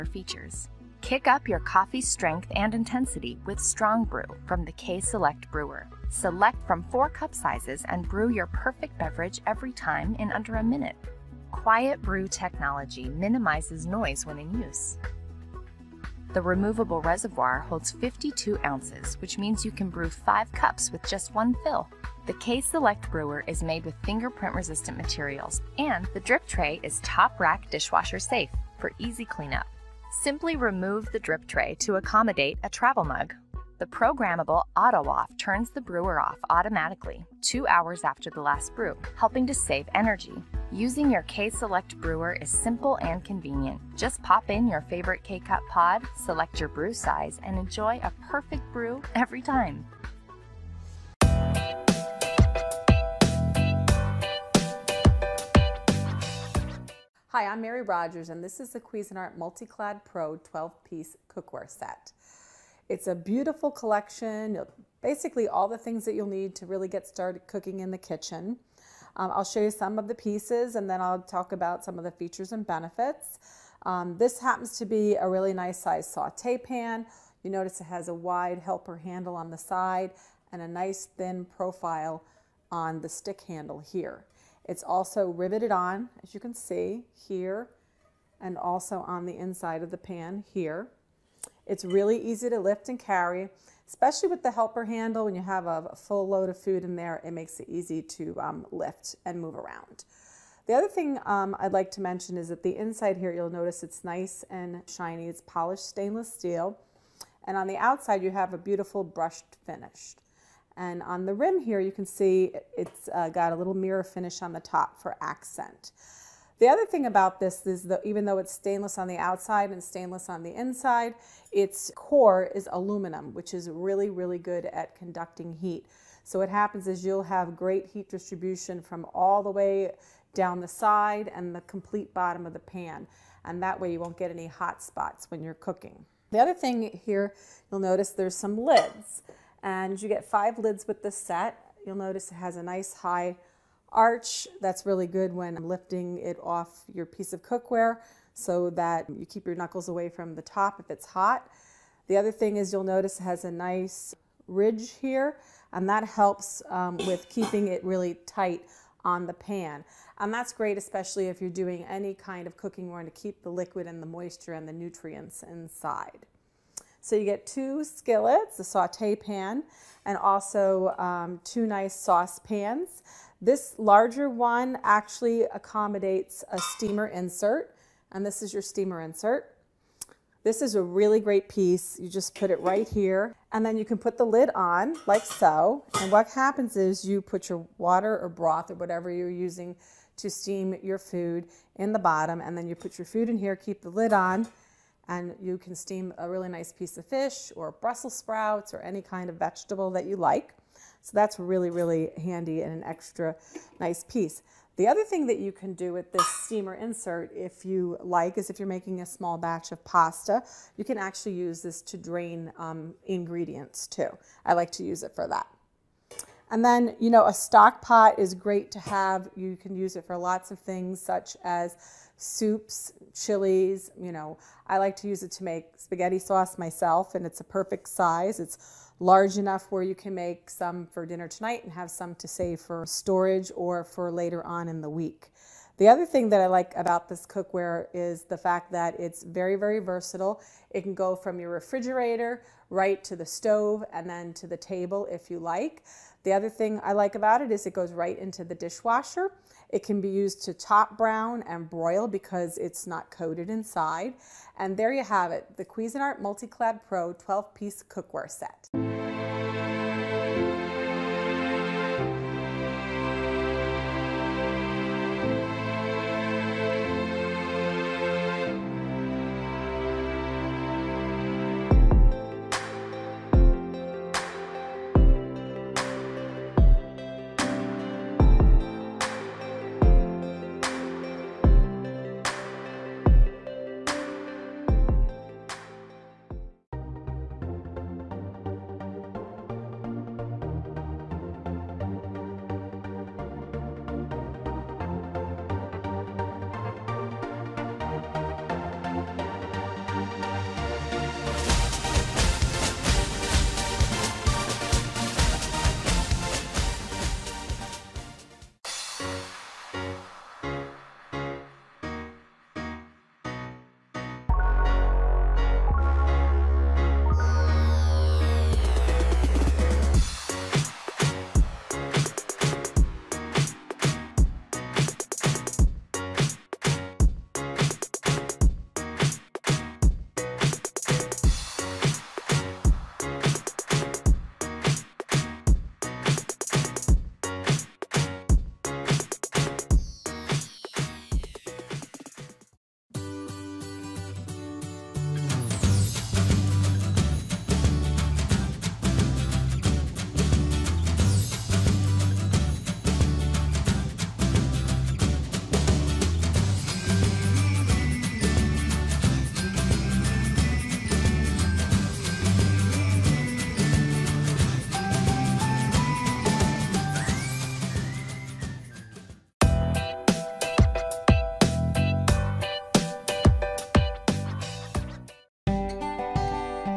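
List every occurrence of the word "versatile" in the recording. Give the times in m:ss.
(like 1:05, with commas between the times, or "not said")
3:59.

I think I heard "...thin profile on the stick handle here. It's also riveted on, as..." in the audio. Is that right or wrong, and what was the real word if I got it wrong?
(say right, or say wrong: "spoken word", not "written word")
right.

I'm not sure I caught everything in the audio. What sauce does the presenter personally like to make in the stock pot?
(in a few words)
Spaghetti sauce.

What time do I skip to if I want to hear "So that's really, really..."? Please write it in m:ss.
3:21.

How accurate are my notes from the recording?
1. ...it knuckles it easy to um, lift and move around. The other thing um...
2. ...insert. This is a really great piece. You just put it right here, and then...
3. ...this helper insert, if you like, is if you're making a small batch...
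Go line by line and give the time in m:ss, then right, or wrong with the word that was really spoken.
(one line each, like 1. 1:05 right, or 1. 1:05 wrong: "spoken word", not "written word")
1. 1:37 wrong: "makes", not "knuckles"
2. 2:59 right
3. 3:26 wrong: "steamer", not "helper".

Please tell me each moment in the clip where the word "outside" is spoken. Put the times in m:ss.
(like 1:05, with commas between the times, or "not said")
1:47, 1:59.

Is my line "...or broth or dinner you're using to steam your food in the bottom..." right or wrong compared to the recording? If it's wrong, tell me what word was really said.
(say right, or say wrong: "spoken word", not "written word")
wrong: "whatever", not "dinner".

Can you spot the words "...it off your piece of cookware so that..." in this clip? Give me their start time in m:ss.
2:26.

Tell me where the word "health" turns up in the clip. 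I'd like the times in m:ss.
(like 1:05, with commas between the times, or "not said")
not said.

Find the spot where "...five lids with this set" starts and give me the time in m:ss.
2:20.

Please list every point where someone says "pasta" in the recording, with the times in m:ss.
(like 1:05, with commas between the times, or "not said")
3:29.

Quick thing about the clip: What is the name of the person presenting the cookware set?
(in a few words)
Mary Rogers.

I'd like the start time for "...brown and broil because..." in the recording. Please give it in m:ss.
4:10.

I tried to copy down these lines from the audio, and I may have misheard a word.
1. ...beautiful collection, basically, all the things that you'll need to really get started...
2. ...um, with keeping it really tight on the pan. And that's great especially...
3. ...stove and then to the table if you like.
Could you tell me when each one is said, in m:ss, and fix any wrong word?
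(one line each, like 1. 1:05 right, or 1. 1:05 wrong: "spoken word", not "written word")
1. 1:03 right
2. 2:36 right
3. 4:03 right.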